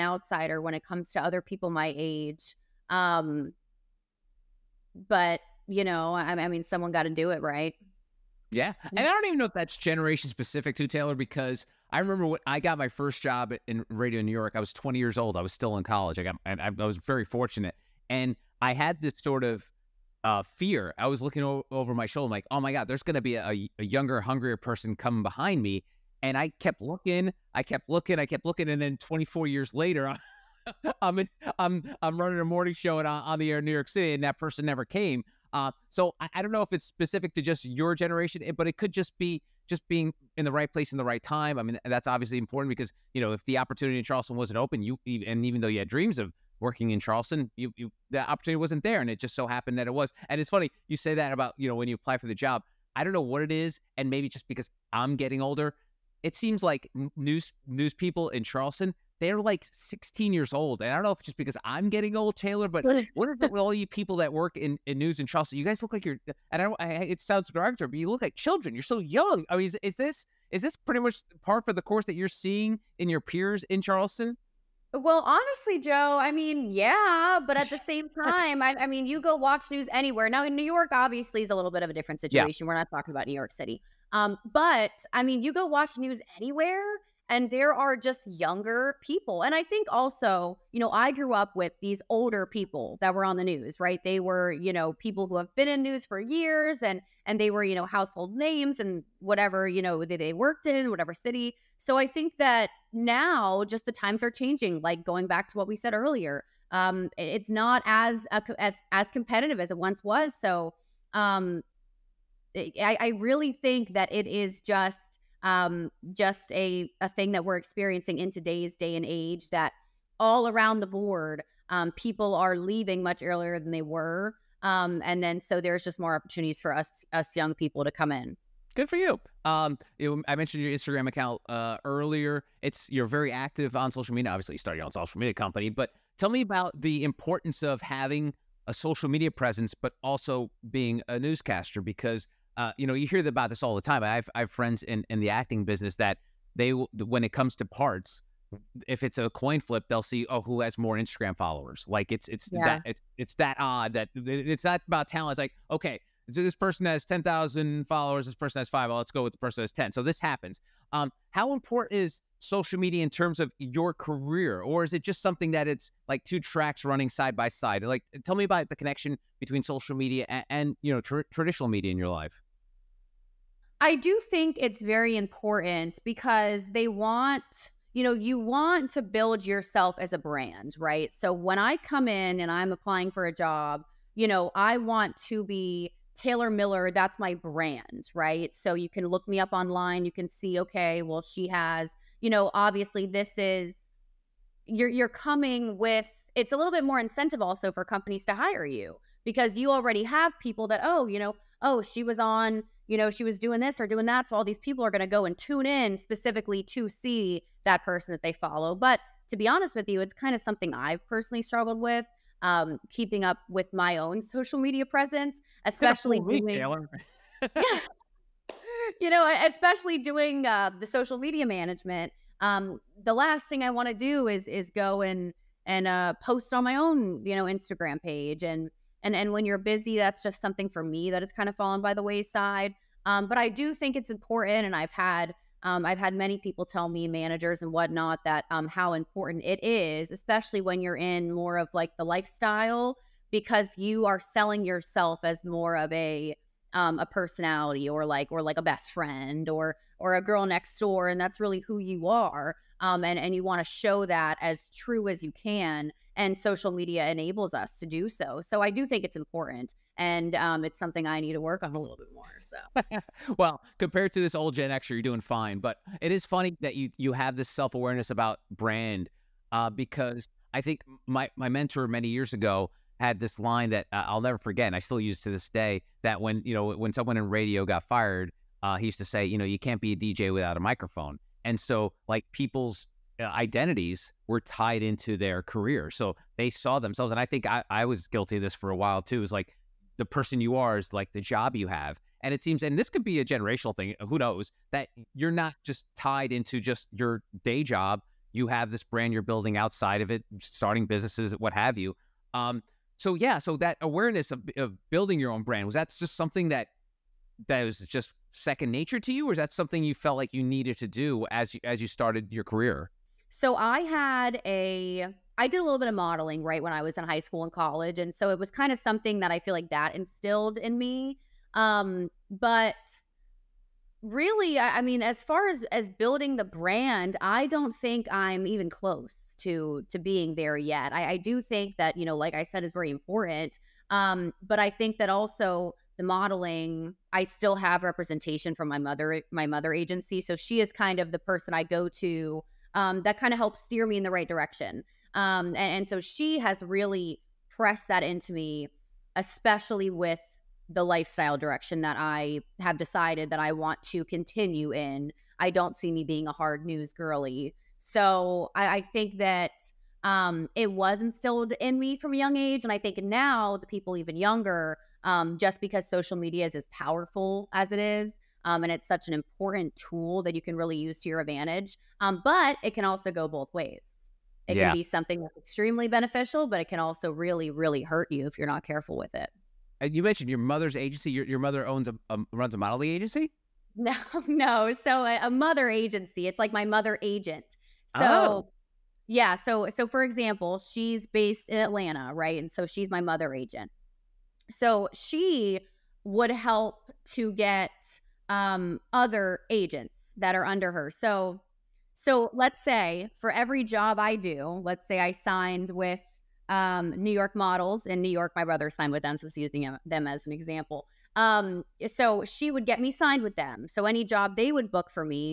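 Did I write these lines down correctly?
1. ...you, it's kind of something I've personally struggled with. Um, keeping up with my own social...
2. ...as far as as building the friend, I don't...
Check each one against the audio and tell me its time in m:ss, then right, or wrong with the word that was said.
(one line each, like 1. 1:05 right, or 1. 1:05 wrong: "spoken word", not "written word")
1. 3:29 right
2. 5:25 wrong: "brand", not "friend".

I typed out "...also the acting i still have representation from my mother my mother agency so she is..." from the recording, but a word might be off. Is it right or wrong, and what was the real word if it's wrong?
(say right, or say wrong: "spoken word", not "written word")
wrong: "modeling", not "acting".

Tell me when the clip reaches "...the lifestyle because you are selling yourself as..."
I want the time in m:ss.
4:01.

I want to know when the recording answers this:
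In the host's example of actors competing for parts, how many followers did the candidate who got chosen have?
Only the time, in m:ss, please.
2:37.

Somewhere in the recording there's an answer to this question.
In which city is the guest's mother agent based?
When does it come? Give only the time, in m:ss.
6:31.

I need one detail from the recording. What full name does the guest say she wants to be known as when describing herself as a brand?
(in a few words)
Taylor Miller.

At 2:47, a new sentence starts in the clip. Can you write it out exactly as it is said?
Like, tell me about the connection between social media and, and you know traditional media in your life.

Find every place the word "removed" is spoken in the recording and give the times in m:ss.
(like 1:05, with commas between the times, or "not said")
not said.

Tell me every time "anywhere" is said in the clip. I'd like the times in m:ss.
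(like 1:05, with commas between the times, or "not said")
1:19, 1:26.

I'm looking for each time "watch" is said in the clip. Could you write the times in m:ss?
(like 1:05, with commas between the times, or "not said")
1:19, 1:25.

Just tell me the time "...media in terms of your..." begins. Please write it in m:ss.
2:42.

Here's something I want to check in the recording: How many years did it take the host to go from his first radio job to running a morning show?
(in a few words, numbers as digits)
24.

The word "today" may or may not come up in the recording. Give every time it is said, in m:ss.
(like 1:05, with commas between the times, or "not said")
1:58.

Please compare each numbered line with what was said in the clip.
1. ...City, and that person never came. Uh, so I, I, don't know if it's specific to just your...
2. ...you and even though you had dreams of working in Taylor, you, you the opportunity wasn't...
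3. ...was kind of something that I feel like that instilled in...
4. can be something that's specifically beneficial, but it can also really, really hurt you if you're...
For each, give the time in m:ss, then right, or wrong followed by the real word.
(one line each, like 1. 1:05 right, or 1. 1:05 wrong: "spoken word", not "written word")
1. 0:33 right
2. 0:44 wrong: "Charleston", not "Taylor"
3. 5:18 right
4. 6:14 wrong: "extremely", not "specifically".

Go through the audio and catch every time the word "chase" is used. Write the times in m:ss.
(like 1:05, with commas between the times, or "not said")
not said.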